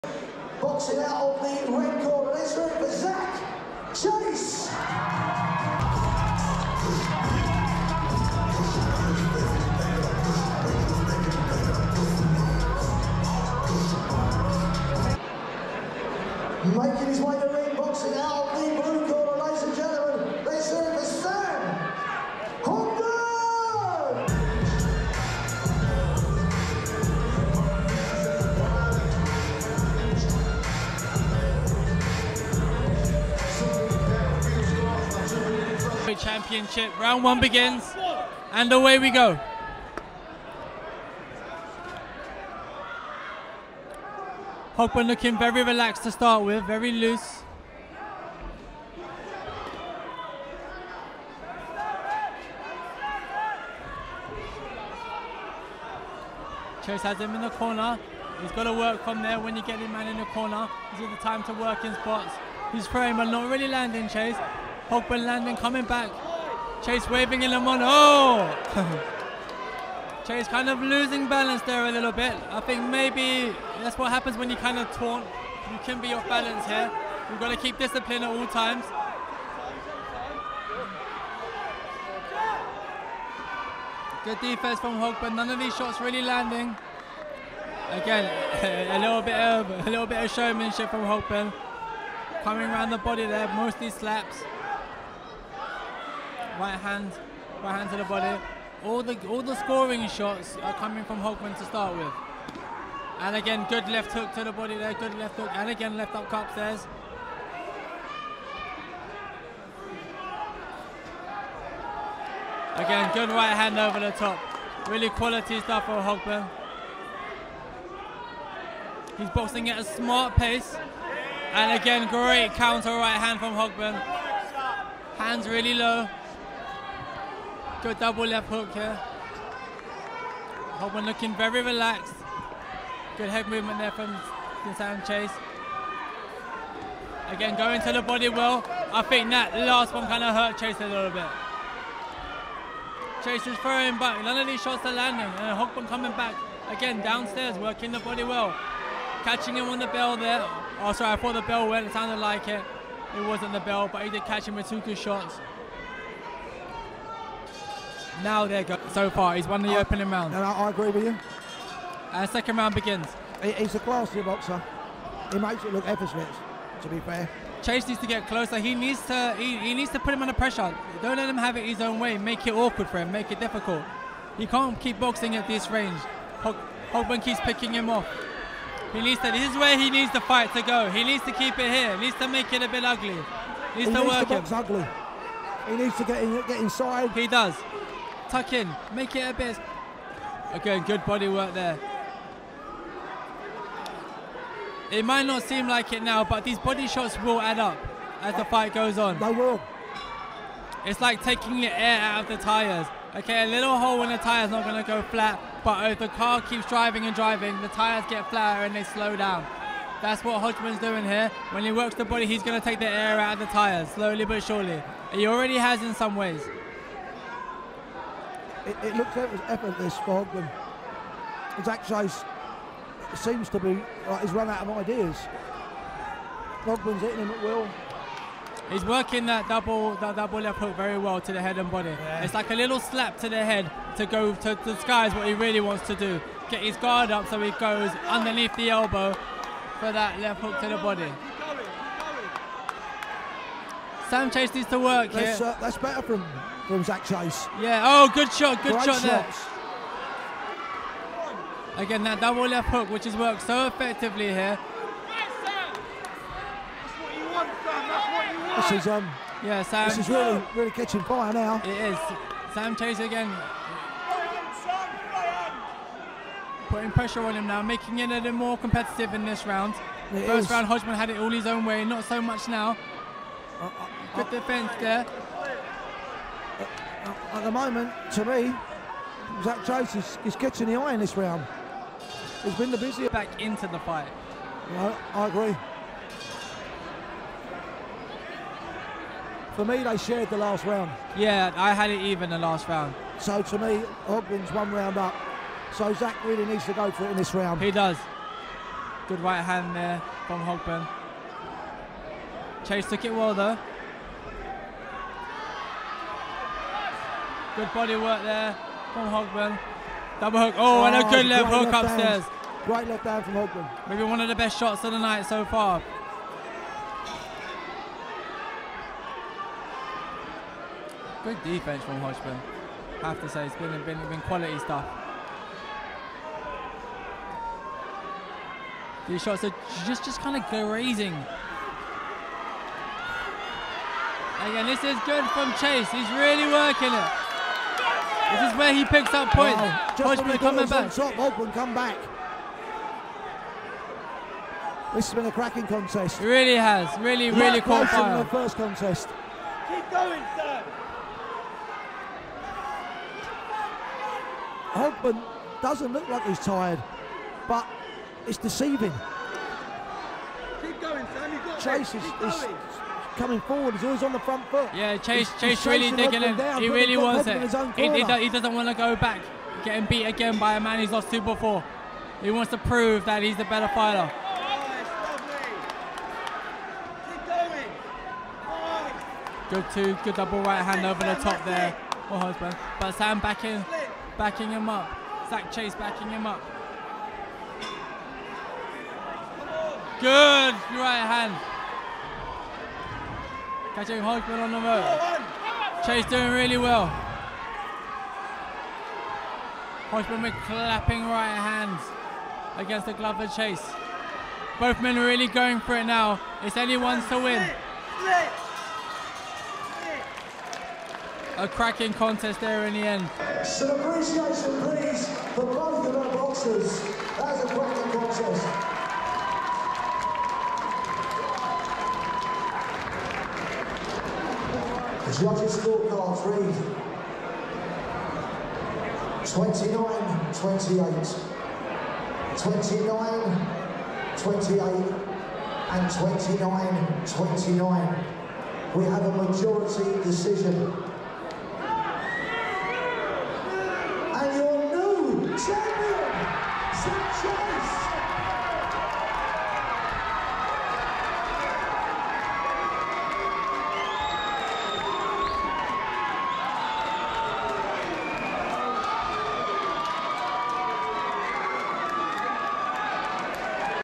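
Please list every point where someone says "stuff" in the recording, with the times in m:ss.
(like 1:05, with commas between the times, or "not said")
1:55, 5:24.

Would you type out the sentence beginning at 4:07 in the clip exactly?
Yeah, oh, good shot, good Great shot shots.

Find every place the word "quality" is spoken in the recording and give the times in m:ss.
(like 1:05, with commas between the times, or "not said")
1:55, 5:24.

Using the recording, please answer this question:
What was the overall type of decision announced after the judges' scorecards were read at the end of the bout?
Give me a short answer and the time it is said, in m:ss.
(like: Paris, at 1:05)
Majority decision, at 7:19.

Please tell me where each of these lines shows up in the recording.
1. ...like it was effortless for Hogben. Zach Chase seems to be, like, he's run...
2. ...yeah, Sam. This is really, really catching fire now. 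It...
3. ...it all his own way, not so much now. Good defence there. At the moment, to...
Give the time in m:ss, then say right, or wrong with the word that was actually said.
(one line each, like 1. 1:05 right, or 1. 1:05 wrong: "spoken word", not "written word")
1. 3:39 right
2. 4:19 right
3. 4:31 right.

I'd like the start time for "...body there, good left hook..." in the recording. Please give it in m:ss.
1:44.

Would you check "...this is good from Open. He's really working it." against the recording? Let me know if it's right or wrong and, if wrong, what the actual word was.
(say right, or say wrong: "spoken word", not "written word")
wrong: "Chase", not "Open".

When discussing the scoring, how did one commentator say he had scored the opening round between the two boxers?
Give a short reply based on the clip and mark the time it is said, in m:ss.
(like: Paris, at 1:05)
Even, at 4:51.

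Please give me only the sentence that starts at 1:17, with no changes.
We've got to keep discipline at all times.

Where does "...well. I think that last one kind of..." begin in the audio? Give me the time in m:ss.
2:18.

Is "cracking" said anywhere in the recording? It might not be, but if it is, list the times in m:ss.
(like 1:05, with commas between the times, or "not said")
5:45, 6:51, 6:57.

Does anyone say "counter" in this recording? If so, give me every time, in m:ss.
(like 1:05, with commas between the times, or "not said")
2:02.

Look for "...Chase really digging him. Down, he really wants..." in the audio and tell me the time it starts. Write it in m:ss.
6:05.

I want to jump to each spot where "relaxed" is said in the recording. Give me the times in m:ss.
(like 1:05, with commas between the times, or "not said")
0:45, 2:11.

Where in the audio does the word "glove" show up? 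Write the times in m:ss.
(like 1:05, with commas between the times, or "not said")
6:42.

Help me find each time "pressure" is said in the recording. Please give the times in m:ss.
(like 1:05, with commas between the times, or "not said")
2:50, 4:26.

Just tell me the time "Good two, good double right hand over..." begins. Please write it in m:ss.
6:19.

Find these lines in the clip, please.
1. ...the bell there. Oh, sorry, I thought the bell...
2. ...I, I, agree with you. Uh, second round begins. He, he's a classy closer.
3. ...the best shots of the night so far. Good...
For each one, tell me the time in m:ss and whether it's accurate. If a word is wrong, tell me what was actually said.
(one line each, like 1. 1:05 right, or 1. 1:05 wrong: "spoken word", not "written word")
1. 2:29 right
2. 2:40 wrong: "boxer", not "closer"
3. 5:14 right.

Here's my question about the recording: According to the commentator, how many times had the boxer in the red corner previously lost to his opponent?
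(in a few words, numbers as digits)
2.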